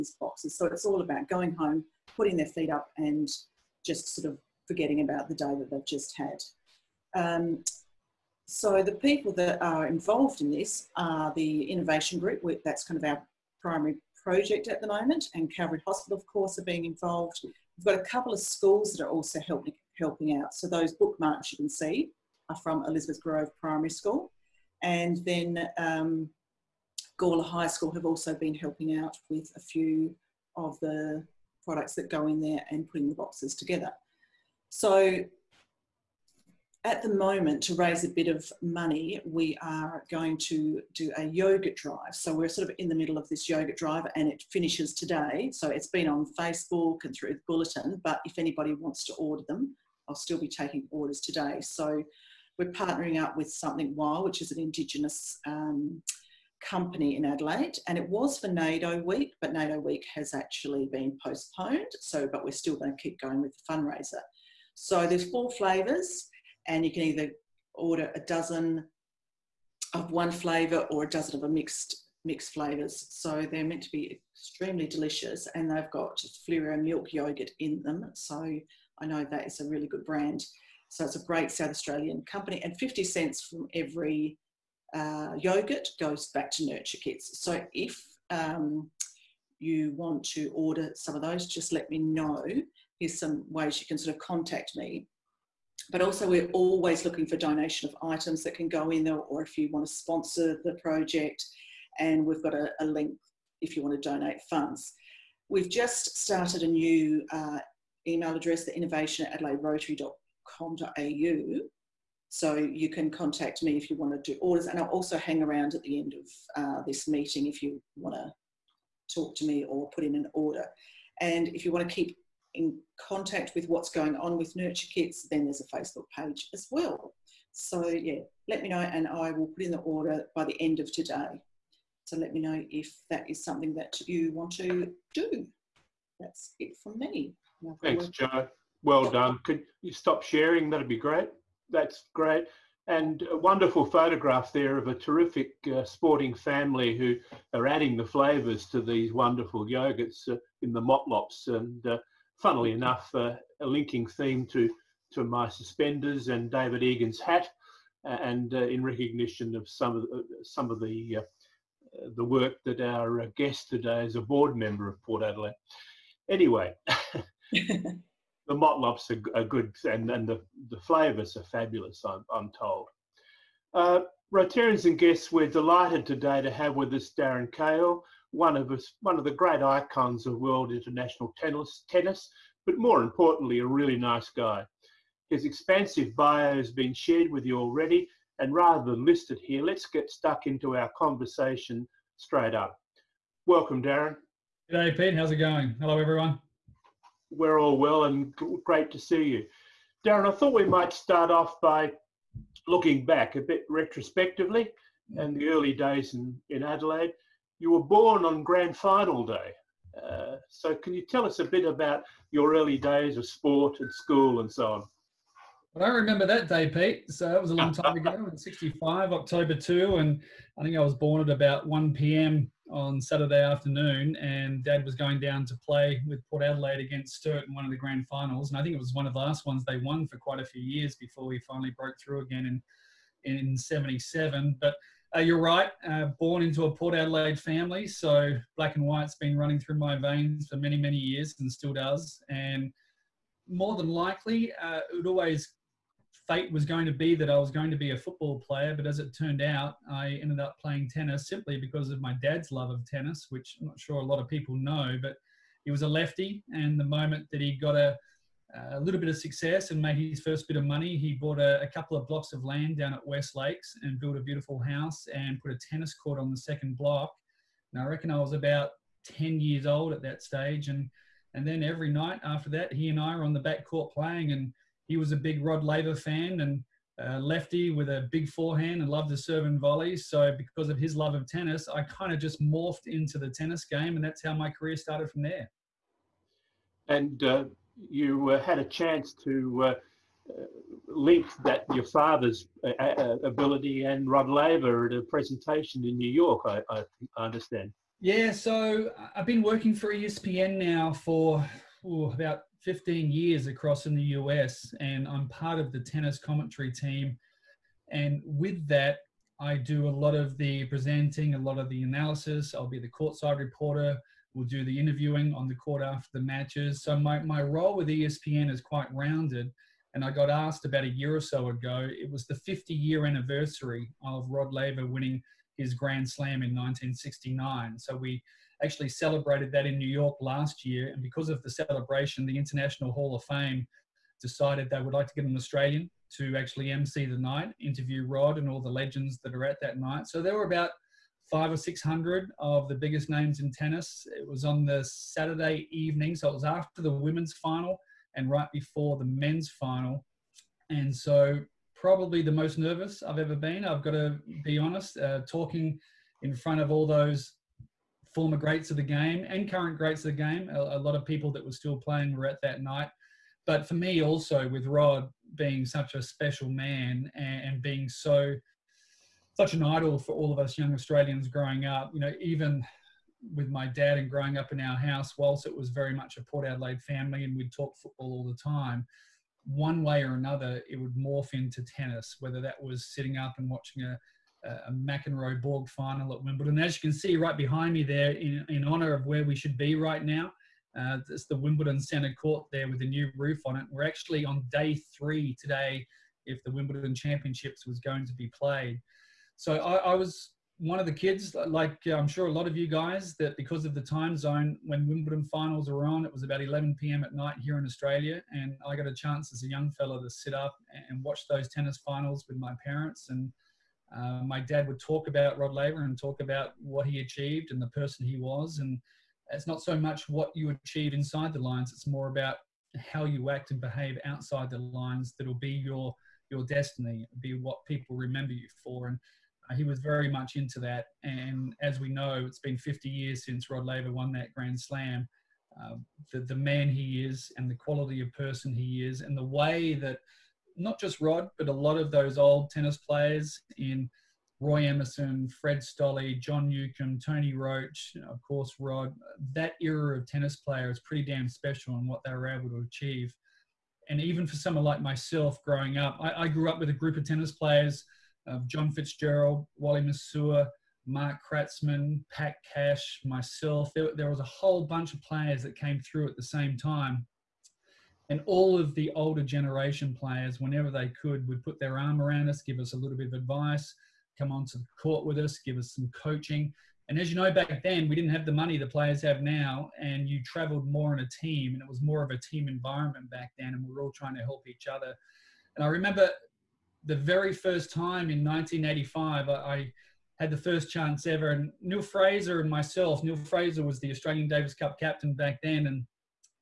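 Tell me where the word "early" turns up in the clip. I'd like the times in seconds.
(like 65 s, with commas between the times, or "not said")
205 s, 212 s.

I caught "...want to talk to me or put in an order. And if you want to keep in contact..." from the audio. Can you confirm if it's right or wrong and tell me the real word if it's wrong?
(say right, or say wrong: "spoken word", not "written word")
right.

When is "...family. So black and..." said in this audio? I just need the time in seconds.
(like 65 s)
237 s.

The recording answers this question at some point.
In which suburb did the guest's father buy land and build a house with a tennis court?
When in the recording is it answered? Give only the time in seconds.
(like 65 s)
263 s.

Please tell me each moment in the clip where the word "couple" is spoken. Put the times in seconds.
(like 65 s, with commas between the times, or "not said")
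18 s, 261 s.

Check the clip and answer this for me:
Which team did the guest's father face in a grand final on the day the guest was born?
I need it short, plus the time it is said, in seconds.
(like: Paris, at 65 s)
Sturt, at 227 s.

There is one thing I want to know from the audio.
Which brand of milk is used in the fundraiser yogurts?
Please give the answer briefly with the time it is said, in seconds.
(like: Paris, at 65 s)
Fleurieu, at 76 s.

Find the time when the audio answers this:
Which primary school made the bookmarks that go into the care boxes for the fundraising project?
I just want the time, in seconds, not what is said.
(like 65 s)
22 s.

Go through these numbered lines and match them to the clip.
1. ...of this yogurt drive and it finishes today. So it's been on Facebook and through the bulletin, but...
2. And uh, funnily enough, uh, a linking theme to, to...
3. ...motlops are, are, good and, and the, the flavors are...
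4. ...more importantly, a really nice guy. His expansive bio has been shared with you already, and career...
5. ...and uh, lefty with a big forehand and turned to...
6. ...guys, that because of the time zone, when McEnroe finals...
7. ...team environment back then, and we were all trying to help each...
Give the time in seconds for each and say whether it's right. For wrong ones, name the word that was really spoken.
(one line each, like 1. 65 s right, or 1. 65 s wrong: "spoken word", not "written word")
1. 43 s right
2. 151 s right
3. 168 s right
4. 182 s wrong: "rather", not "career"
5. 276 s wrong: "loved", not "turned"
6. 402 s wrong: "Wimbledon", not "McEnroe"
7. 482 s right.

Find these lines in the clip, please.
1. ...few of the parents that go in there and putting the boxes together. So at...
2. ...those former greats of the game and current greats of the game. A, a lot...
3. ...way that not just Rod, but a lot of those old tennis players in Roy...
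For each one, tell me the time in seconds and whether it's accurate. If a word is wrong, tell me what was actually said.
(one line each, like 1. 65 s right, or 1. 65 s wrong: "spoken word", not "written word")
1. 29 s wrong: "products", not "parents"
2. 356 s right
3. 439 s right.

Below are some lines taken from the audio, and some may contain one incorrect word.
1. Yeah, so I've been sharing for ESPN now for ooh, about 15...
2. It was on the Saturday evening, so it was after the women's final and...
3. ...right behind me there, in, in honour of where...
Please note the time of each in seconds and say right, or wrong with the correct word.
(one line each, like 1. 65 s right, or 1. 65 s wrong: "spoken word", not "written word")
1. 298 s wrong: "working", not "sharing"
2. 344 s right
3. 387 s right.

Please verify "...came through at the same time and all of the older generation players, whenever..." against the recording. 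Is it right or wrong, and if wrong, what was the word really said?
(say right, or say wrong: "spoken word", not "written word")
right.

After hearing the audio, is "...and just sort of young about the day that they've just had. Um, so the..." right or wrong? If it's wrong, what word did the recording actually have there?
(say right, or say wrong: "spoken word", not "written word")
wrong: "forgetting", not "young".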